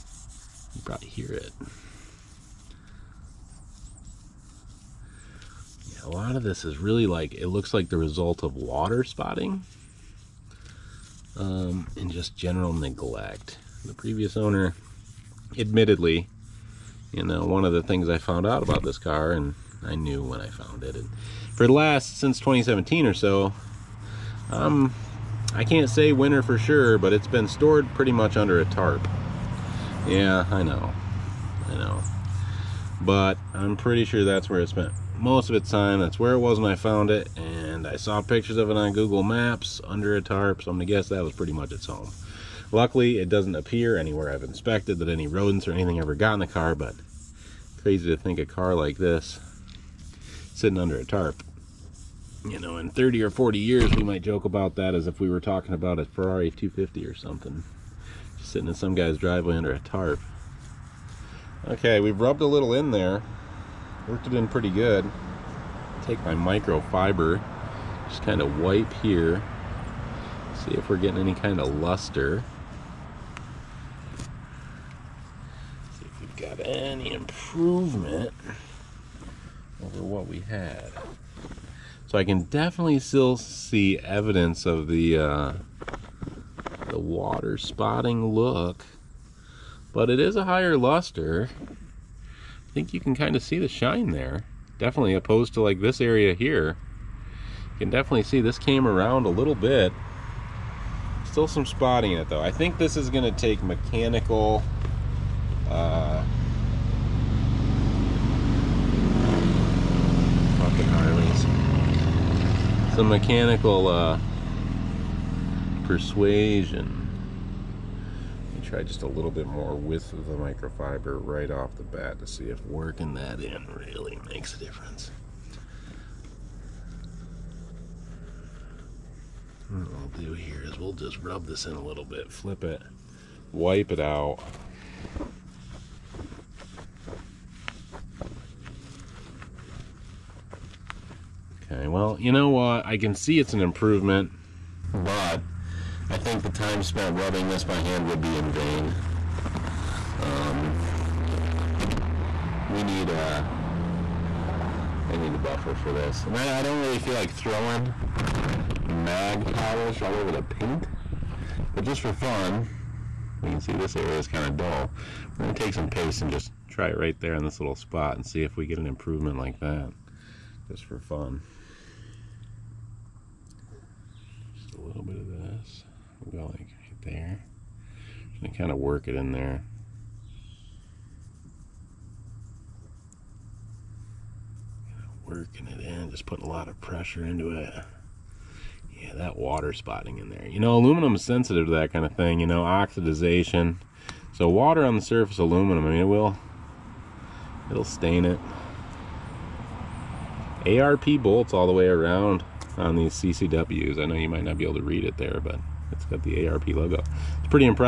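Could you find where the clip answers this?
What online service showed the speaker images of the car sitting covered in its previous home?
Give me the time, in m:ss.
0:38.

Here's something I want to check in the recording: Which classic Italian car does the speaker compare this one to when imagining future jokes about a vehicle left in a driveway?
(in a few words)
Ferrari 250.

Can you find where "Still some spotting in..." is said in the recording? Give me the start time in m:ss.
1:41.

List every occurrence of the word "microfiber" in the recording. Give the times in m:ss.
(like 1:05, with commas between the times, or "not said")
1:06, 2:00.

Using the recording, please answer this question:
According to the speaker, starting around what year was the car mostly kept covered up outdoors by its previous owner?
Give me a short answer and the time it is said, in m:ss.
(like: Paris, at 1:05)
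2017, at 0:22.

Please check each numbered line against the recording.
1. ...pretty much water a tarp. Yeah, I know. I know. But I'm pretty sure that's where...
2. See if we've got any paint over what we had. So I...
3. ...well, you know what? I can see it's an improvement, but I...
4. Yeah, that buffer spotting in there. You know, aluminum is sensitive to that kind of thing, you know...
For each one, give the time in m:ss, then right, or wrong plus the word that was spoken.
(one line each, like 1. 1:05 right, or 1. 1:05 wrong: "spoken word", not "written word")
1. 0:27 wrong: "under", not "water"
2. 1:15 wrong: "improvement", not "paint"
3. 2:21 right
4. 3:08 wrong: "water", not "buffer".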